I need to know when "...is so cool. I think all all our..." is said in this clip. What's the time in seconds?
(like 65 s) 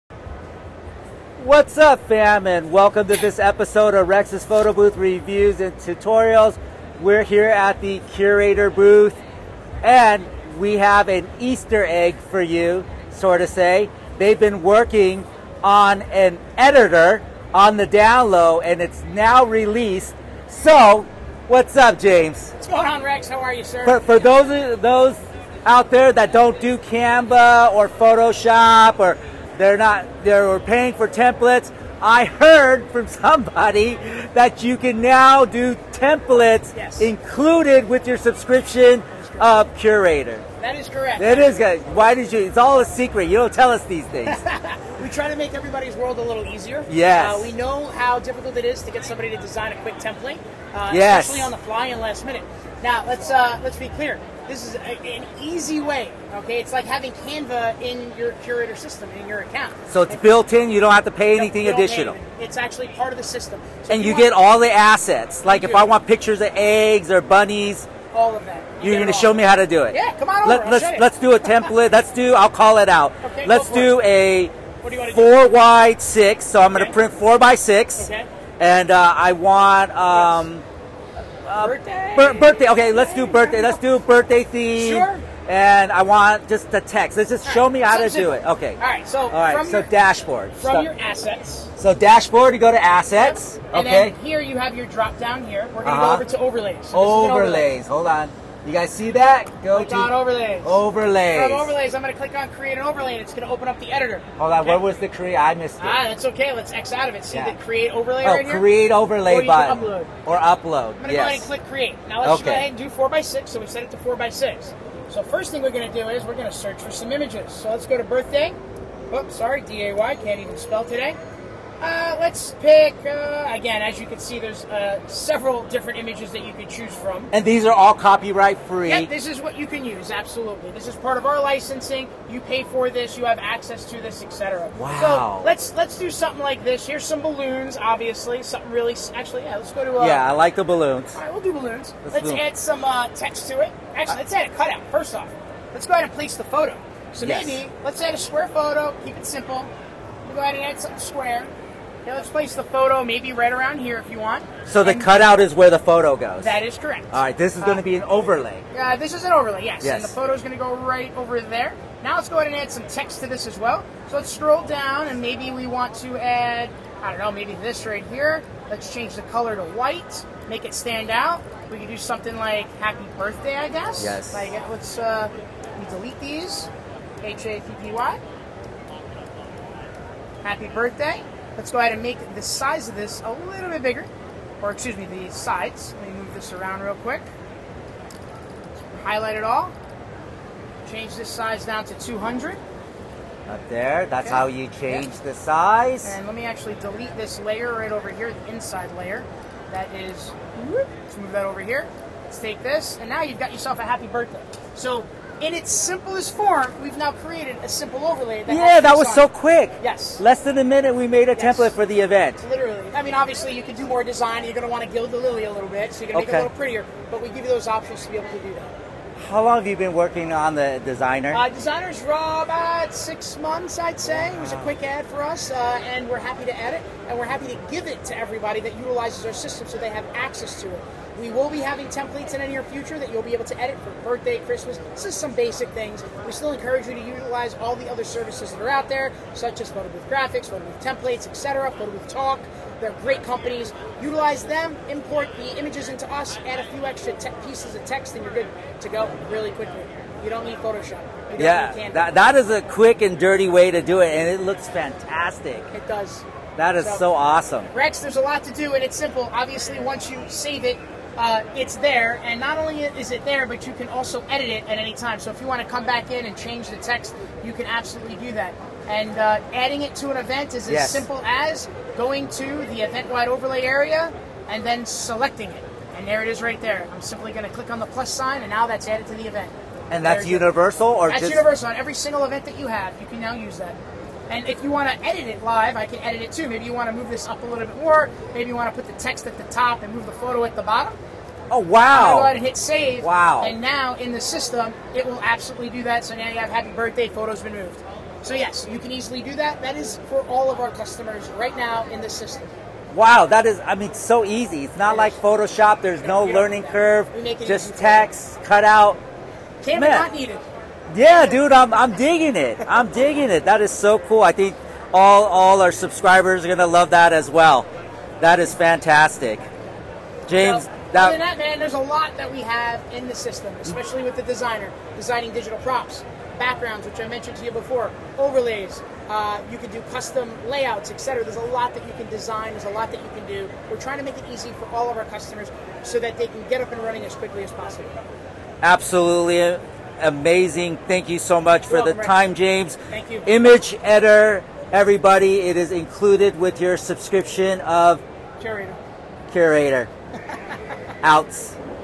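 313 s.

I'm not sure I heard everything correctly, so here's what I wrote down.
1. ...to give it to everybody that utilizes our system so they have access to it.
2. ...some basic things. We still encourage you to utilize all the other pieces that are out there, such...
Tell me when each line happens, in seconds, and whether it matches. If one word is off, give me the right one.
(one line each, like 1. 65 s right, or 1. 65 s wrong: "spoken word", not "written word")
1. 227 s right
2. 235 s wrong: "services", not "pieces".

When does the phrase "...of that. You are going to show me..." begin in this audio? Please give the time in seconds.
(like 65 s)
68 s.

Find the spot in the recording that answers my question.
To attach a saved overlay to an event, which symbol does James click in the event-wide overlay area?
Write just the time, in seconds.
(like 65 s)
277 s.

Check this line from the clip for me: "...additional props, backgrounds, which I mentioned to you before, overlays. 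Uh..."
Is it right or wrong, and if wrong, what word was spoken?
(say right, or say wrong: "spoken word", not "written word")
wrong: "digital", not "additional".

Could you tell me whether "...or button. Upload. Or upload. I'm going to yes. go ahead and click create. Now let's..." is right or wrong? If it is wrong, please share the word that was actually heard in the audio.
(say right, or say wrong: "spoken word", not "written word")
right.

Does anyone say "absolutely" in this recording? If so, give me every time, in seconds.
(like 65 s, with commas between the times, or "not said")
130 s, 267 s, 295 s, 338 s.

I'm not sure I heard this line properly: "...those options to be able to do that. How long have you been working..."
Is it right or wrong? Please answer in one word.
right.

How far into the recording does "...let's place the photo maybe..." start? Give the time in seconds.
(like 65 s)
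152 s.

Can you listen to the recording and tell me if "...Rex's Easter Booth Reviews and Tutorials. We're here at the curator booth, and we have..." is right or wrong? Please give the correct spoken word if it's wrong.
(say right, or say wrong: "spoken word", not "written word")
wrong: "Photo", not "Easter".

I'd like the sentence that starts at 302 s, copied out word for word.
Wow, that is, I mean, so easy.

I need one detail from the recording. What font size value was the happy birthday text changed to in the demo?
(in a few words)
200.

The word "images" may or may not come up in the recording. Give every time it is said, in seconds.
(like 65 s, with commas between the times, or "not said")
117 s, 125 s, 245 s, 343 s.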